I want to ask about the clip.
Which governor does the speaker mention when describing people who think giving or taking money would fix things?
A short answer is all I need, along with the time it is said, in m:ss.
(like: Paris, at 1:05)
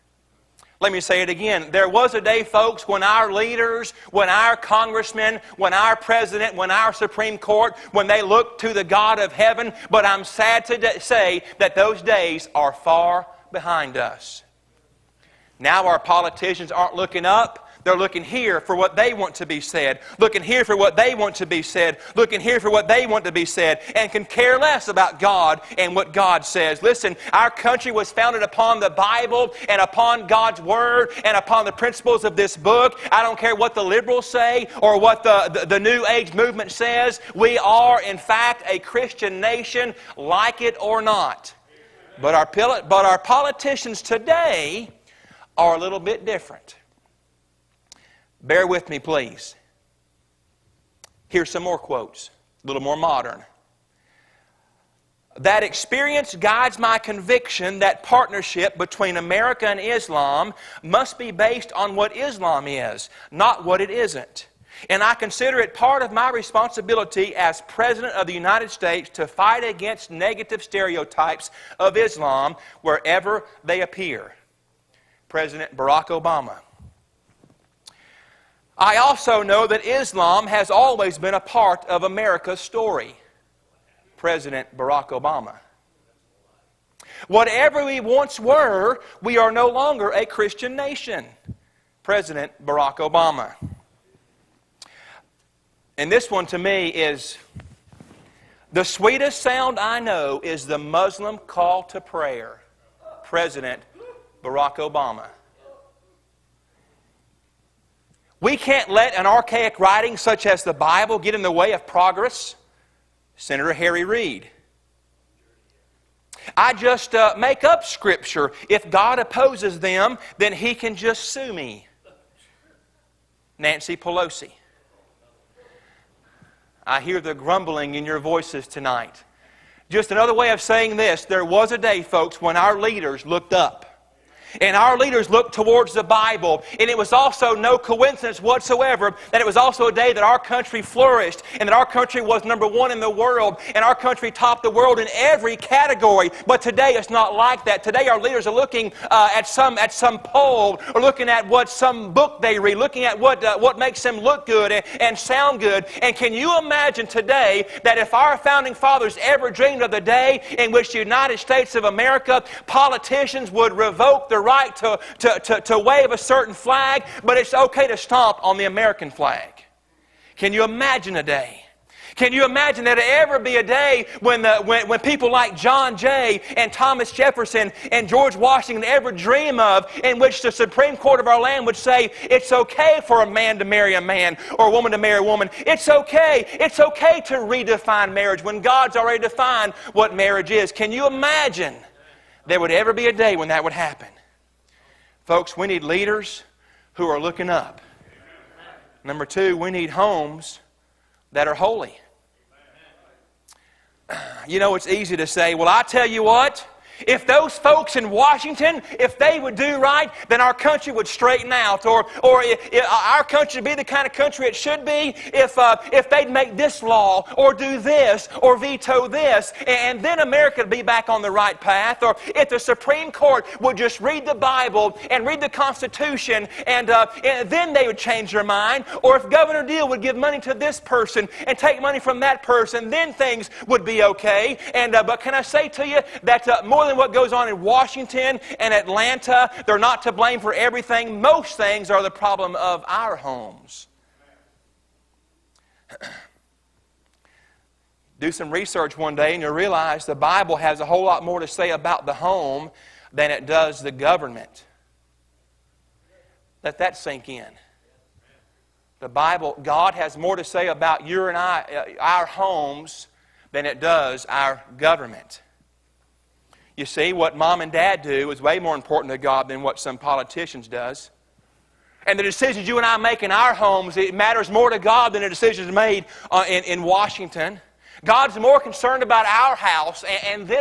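Governor Deal, at 3:49.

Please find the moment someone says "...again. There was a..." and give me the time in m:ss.
0:01.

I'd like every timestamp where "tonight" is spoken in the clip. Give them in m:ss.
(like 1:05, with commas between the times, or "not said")
2:08.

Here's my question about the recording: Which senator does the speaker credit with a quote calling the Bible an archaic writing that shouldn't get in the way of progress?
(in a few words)
Harry Reid.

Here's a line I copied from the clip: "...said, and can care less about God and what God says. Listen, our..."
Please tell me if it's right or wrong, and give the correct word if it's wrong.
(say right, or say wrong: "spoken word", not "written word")
right.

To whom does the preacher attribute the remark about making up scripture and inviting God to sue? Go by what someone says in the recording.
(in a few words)
Nancy Pelosi.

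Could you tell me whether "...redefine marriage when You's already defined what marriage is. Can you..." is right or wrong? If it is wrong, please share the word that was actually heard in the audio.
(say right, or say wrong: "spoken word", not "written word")
wrong: "God", not "You".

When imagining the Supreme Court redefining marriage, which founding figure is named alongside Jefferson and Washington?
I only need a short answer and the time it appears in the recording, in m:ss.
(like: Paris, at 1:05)
John Jay, at 2:55.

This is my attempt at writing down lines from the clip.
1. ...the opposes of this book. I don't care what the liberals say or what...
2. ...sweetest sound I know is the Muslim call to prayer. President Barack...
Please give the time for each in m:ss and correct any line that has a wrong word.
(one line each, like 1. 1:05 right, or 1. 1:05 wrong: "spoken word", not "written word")
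1. 0:31 wrong: "principles", not "opposes"
2. 1:38 right.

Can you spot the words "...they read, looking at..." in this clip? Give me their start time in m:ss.
2:32.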